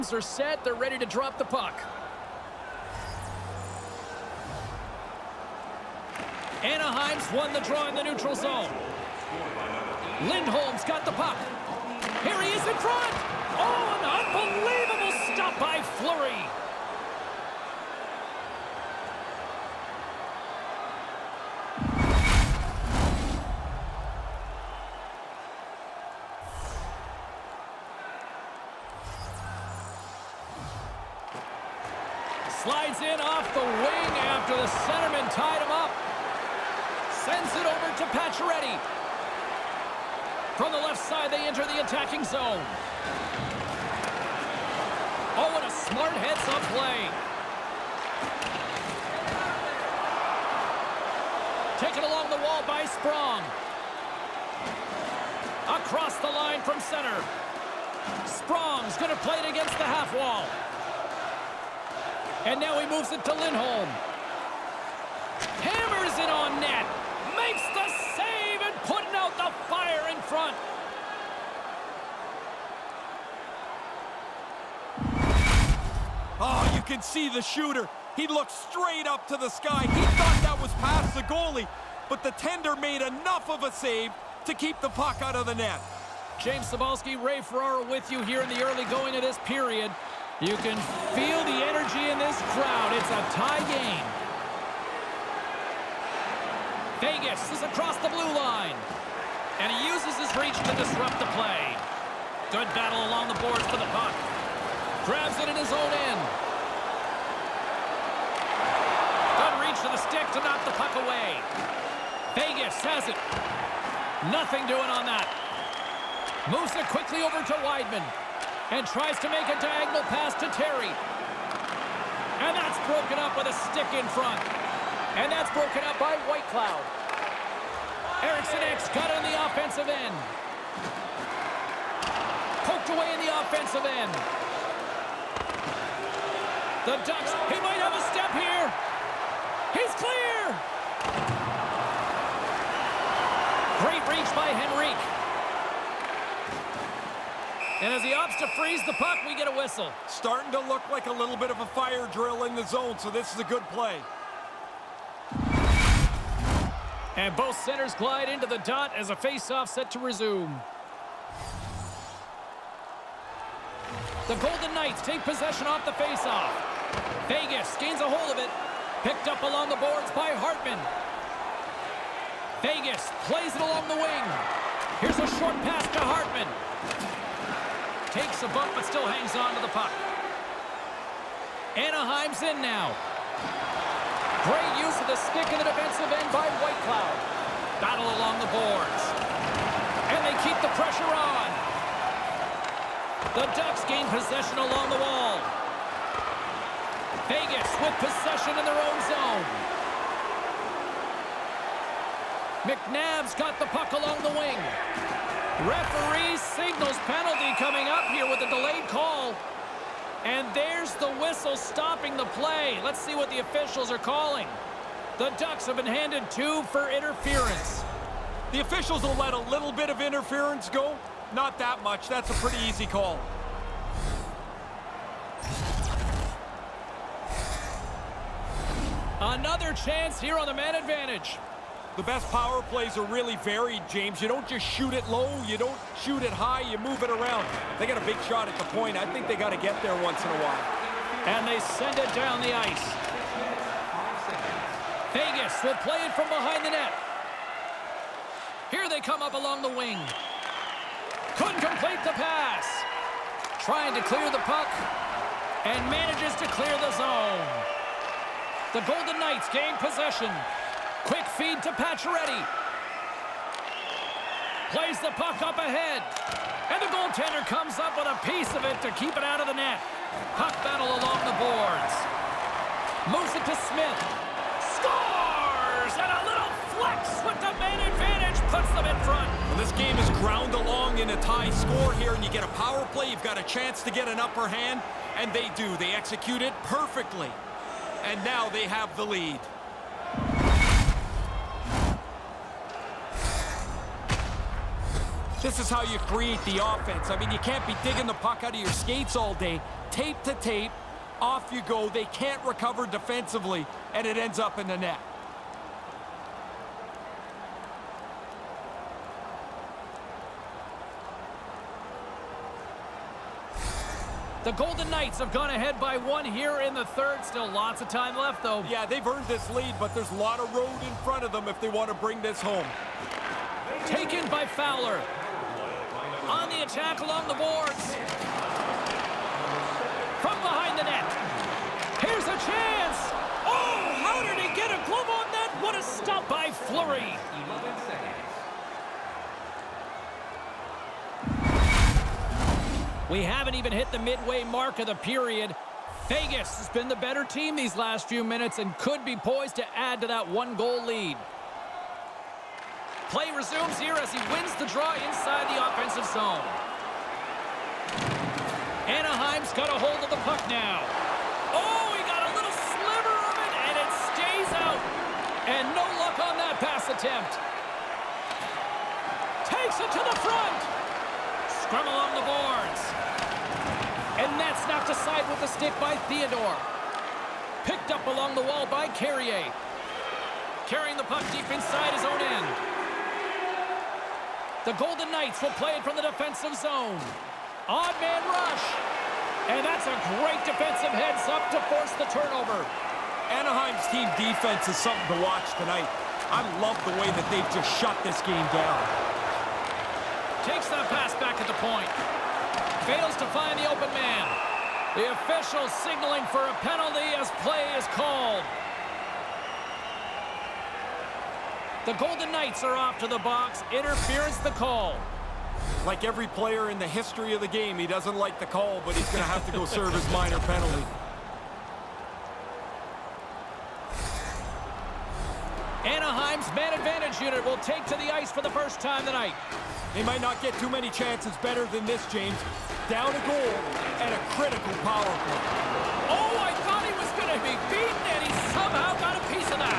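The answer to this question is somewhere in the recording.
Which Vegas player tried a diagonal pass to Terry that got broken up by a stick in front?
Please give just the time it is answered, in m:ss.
1:57.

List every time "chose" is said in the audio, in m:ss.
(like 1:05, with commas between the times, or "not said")
not said.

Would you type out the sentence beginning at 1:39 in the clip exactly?
And he uses his reach to disrupt the play.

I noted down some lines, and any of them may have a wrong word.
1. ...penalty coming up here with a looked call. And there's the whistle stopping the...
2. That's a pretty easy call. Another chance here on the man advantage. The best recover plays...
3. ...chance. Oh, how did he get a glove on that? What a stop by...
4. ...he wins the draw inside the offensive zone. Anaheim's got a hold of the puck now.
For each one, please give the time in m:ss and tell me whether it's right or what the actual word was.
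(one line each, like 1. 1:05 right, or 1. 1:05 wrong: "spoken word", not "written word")
1. 3:27 wrong: "delayed", not "looked"
2. 3:42 wrong: "power", not "recover"
3. 5:32 right
4. 5:54 right.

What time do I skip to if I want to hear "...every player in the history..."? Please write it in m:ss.
6:56.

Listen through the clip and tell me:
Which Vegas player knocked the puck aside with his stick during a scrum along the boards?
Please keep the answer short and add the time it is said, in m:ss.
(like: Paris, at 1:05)
Theodore, at 6:16.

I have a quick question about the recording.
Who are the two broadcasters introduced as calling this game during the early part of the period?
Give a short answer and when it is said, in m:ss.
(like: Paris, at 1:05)
James Cybulski, Ray Ferraro, at 1:26.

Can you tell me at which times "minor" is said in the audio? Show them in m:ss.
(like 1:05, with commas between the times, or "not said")
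7:00.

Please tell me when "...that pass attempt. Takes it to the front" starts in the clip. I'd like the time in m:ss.
6:06.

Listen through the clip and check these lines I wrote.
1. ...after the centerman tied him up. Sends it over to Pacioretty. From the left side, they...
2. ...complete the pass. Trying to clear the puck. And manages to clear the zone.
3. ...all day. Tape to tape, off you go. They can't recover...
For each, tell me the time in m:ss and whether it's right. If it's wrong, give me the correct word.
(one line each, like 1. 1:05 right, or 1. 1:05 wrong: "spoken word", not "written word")
1. 0:34 right
2. 4:11 right
3. 4:59 right.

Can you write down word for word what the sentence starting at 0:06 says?
Anaheim's won the draw in the neutral zone.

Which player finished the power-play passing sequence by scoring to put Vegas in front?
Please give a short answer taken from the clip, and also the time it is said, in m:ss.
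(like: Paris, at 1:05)
Smith, at 4:33.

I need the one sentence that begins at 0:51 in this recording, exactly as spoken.
Taken along the wall by Sprong.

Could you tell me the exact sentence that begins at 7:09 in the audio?
They might not get too many chances better than this, James.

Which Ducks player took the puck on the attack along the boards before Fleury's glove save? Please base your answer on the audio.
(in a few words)
Fowler.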